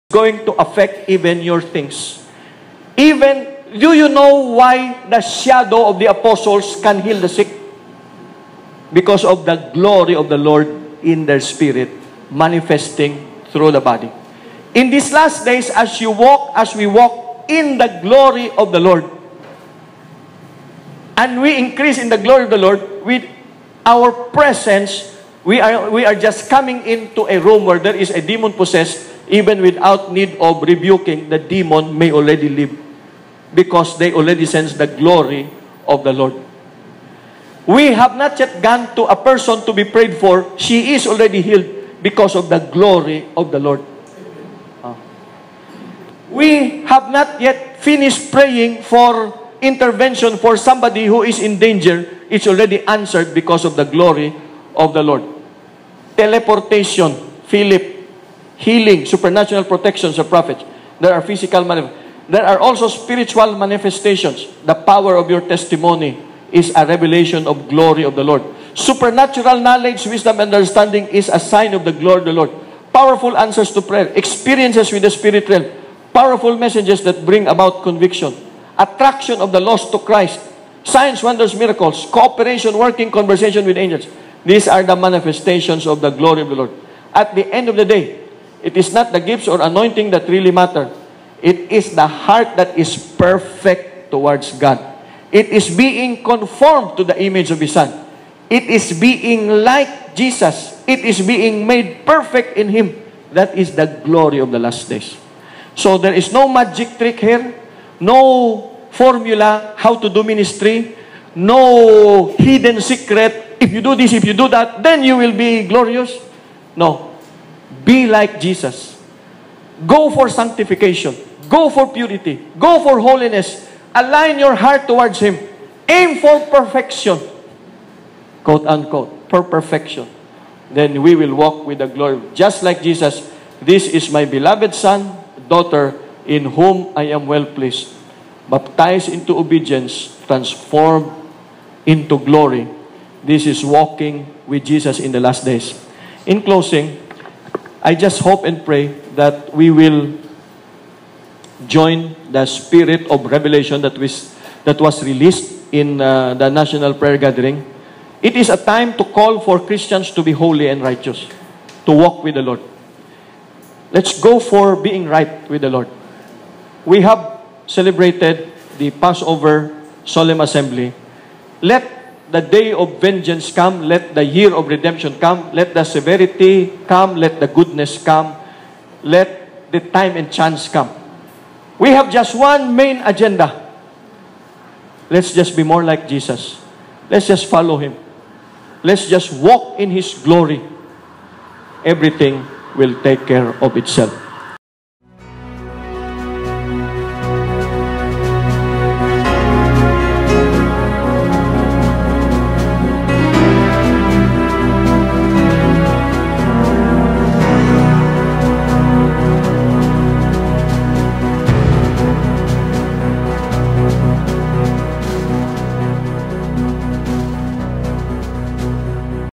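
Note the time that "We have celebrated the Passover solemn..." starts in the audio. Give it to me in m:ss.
2:46.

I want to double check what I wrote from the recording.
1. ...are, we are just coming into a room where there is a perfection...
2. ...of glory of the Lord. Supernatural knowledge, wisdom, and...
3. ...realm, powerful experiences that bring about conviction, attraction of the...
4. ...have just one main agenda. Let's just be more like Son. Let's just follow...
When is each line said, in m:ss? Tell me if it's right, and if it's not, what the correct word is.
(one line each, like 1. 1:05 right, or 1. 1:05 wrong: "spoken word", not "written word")
1. 0:25 wrong: "demon", not "perfection"
2. 1:07 right
3. 1:15 wrong: "messages", not "experiences"
4. 3:01 wrong: "Jesus", not "Son".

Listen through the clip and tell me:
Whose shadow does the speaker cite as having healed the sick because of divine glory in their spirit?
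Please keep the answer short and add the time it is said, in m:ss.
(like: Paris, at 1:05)
The apostles, at 0:05.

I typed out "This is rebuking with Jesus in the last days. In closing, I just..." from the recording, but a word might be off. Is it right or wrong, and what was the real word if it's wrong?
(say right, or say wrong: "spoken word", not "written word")
wrong: "walking", not "rebuking".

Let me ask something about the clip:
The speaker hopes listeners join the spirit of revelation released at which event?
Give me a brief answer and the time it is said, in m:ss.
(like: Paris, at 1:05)
National prayer gathering, at 2:36.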